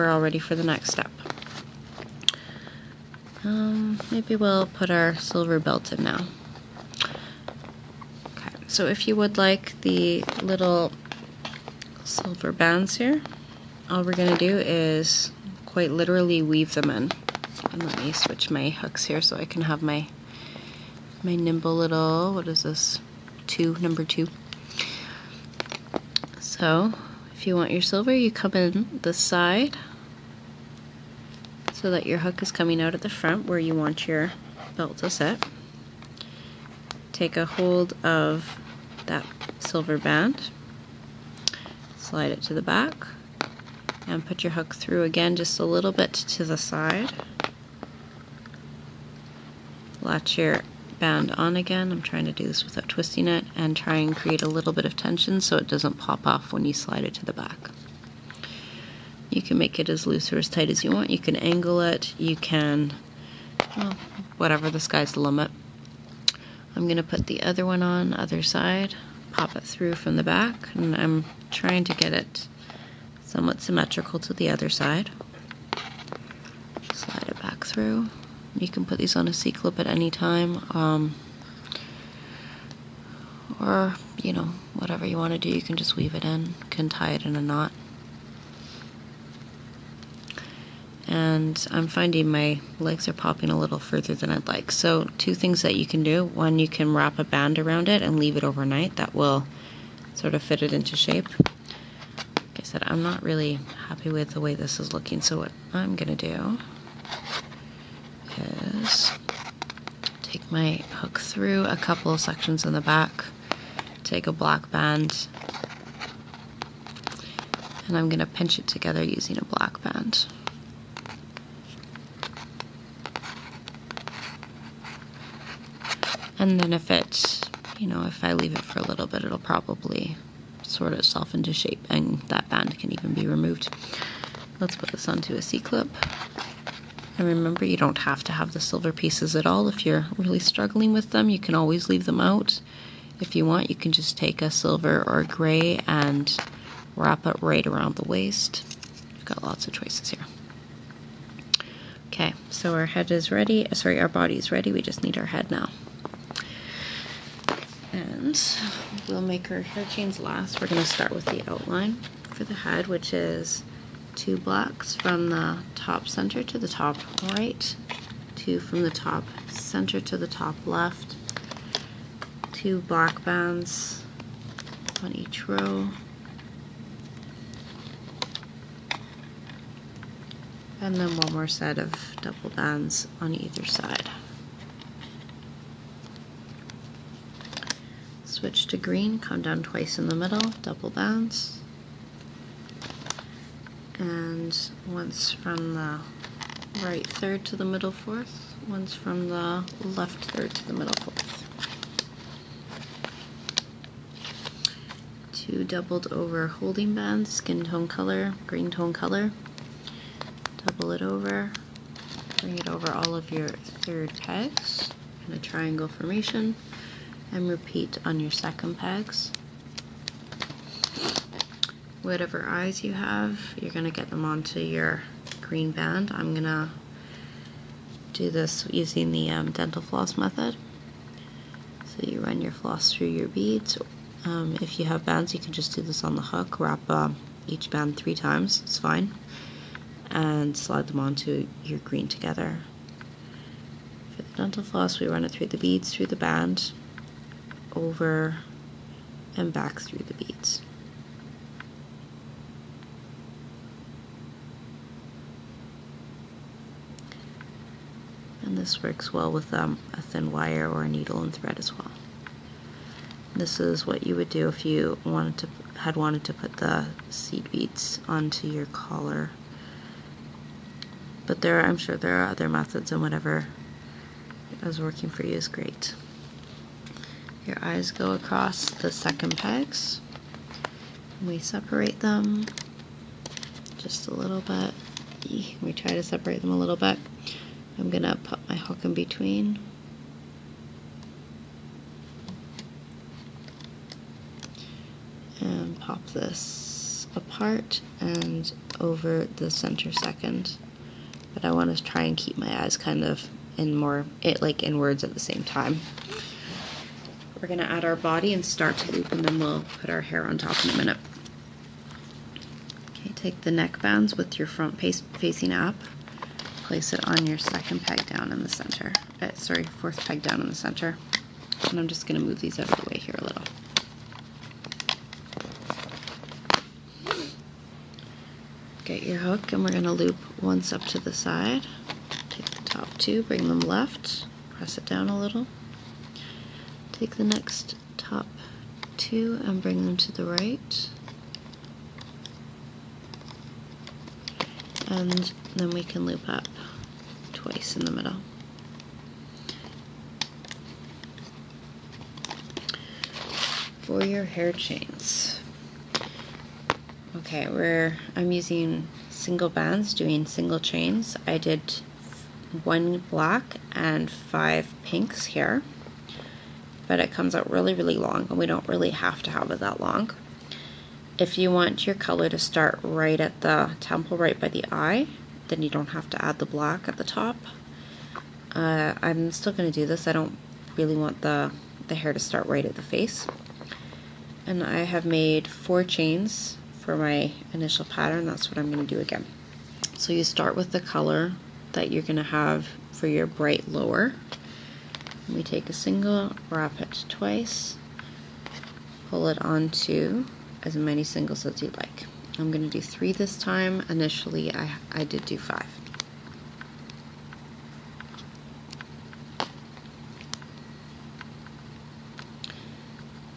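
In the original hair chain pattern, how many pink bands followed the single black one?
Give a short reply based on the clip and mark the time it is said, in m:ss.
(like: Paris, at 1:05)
5, at 6:04.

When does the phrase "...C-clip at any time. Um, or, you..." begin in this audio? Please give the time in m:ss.
1:19.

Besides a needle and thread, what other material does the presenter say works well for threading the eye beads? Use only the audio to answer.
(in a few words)
thin wire.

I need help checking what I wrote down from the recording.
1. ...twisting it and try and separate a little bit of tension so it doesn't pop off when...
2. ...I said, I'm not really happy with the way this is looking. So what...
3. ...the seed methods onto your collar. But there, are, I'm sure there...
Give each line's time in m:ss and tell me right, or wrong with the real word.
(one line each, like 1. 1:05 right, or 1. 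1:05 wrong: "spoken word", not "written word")
1. 0:52 wrong: "create", not "separate"
2. 1:42 right
3. 4:26 wrong: "beads", not "methods".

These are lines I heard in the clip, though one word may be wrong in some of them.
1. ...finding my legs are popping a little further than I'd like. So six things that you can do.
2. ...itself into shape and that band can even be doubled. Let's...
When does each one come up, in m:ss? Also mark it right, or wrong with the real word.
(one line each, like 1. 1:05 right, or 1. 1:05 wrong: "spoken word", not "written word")
1. 1:31 wrong: "two", not "six"
2. 2:10 wrong: "removed", not "doubled".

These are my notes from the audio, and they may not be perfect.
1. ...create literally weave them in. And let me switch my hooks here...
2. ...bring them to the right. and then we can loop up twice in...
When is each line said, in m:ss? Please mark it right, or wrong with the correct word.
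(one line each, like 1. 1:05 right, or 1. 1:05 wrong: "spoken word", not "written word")
1. 0:15 wrong: "quite", not "create"
2. 5:39 right.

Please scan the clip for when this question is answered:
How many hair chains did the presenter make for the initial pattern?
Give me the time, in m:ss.
6:25.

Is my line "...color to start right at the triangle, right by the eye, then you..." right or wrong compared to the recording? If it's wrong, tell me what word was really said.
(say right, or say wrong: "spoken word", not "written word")
wrong: "temple", not "triangle".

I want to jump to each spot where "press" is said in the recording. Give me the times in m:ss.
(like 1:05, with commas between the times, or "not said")
5:34.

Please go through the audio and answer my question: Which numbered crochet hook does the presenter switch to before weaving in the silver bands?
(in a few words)
2.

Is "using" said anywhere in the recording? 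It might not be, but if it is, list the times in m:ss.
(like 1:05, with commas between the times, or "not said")
1:59, 3:48, 5:58.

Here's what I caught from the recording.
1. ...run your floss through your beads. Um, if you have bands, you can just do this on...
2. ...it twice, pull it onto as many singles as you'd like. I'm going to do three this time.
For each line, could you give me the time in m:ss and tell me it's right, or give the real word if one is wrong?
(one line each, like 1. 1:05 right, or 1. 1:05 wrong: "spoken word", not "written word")
1. 3:52 right
2. 6:36 right.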